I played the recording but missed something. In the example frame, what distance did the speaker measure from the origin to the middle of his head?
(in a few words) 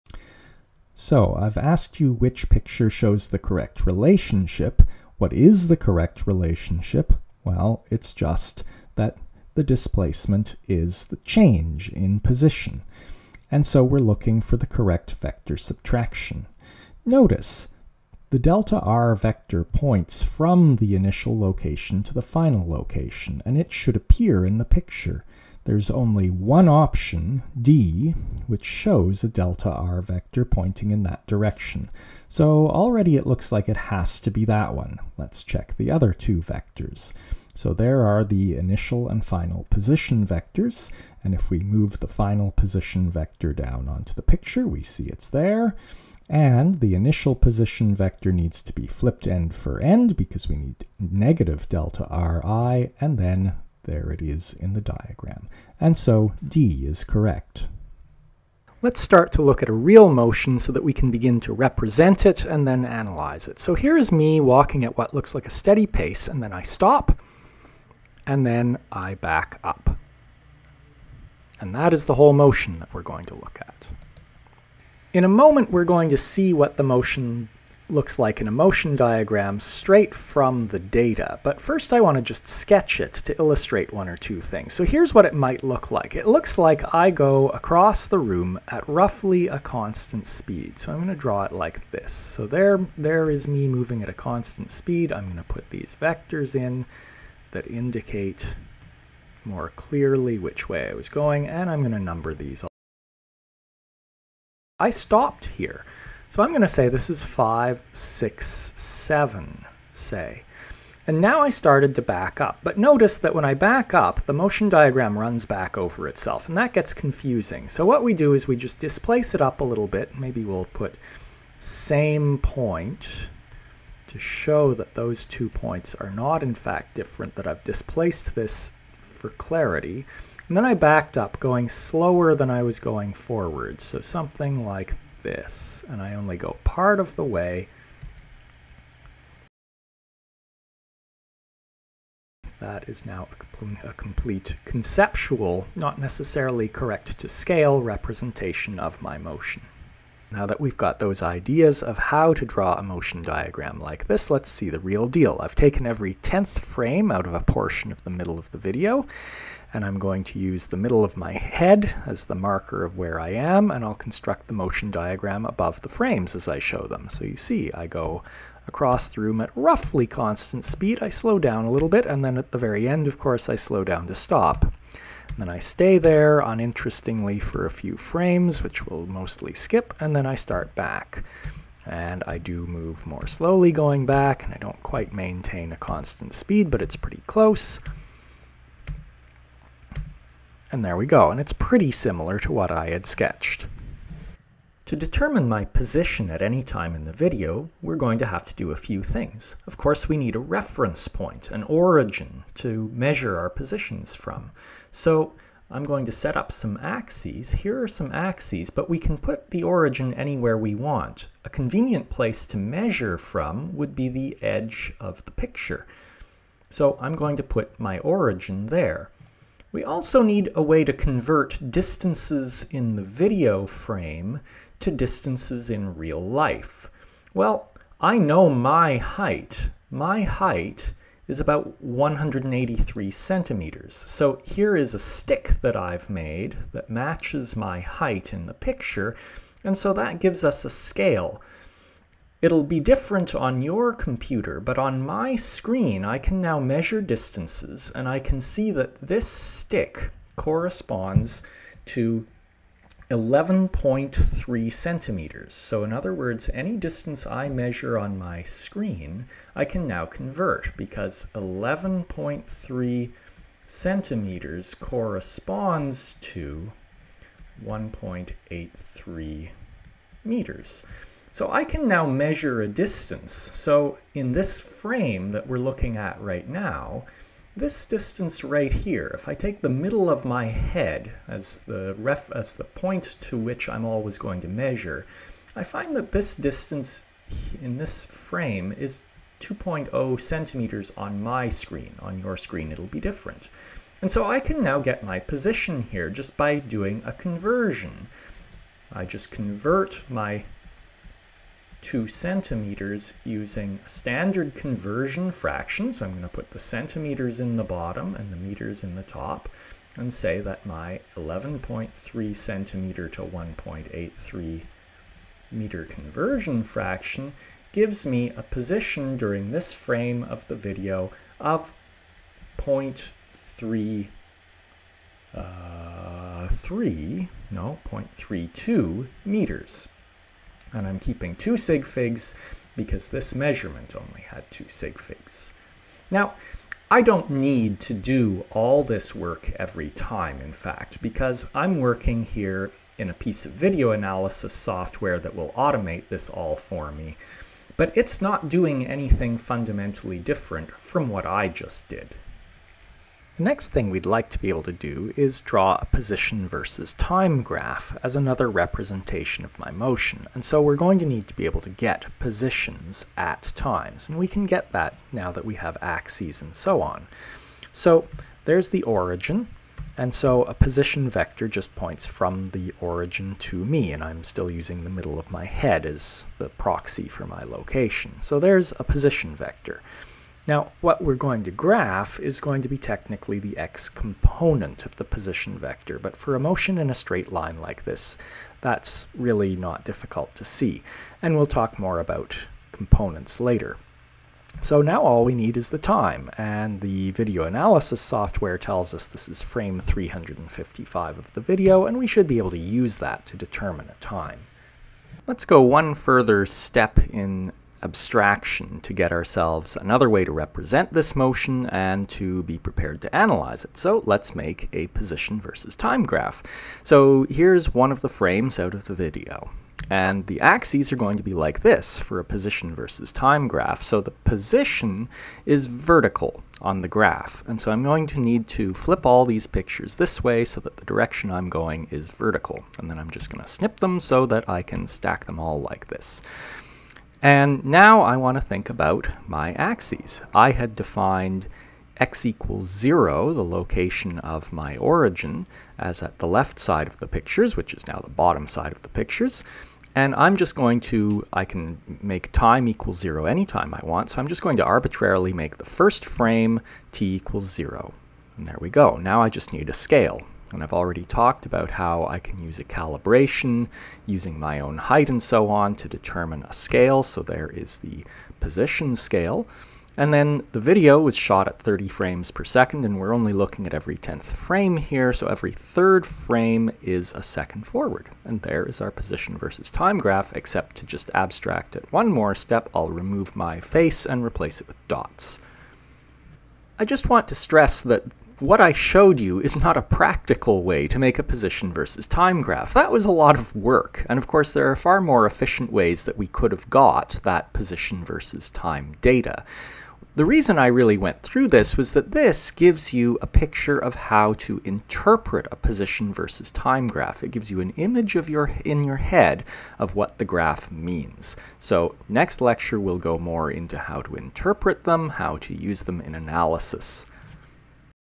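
2.0 centimeters.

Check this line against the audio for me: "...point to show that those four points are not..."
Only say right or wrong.
wrong.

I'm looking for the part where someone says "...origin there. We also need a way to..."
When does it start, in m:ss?
3:37.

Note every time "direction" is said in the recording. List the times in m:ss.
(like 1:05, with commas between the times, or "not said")
0:31, 7:10.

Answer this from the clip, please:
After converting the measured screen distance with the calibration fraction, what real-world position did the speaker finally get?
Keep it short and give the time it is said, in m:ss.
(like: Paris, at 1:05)
0.32 meters, at 5:27.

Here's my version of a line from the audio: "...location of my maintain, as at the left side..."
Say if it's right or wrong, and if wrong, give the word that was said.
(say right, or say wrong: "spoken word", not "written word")
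wrong: "origin", not "maintain".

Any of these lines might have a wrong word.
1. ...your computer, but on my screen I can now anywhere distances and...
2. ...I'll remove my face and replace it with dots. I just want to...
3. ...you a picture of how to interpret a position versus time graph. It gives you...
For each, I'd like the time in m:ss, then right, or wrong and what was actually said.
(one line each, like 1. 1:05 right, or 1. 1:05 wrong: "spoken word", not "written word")
1. 4:03 wrong: "measure", not "anywhere"
2. 8:02 right
3. 8:22 right.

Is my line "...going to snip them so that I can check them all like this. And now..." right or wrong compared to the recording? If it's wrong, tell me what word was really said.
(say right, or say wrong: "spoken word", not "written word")
wrong: "stack", not "check".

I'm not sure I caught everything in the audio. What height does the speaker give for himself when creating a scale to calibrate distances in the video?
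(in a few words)
183 centimeters.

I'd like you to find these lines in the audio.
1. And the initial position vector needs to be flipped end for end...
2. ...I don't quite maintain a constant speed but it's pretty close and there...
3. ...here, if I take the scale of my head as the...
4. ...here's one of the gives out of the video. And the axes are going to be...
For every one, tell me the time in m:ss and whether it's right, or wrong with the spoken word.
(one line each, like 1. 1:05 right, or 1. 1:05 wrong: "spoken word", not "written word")
1. 0:46 right
2. 3:04 right
3. 4:38 wrong: "middle", not "scale"
4. 6:57 wrong: "frames", not "gives".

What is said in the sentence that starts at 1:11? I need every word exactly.
And that is the whole motion that we're going to look at.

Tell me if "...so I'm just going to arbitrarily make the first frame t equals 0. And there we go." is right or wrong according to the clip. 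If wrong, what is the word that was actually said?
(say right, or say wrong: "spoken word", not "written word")
right.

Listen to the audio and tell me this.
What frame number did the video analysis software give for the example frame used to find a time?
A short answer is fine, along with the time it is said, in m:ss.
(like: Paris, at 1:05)
355, at 6:39.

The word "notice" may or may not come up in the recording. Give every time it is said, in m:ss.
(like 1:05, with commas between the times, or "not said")
0:17, 1:52.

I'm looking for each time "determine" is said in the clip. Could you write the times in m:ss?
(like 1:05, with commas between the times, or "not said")
3:14, 6:43, 7:45.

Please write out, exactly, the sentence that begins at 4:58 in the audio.
I just convert my two centimeters using standard conversion fraction.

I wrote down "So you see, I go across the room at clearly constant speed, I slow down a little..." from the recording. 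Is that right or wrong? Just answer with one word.
wrong.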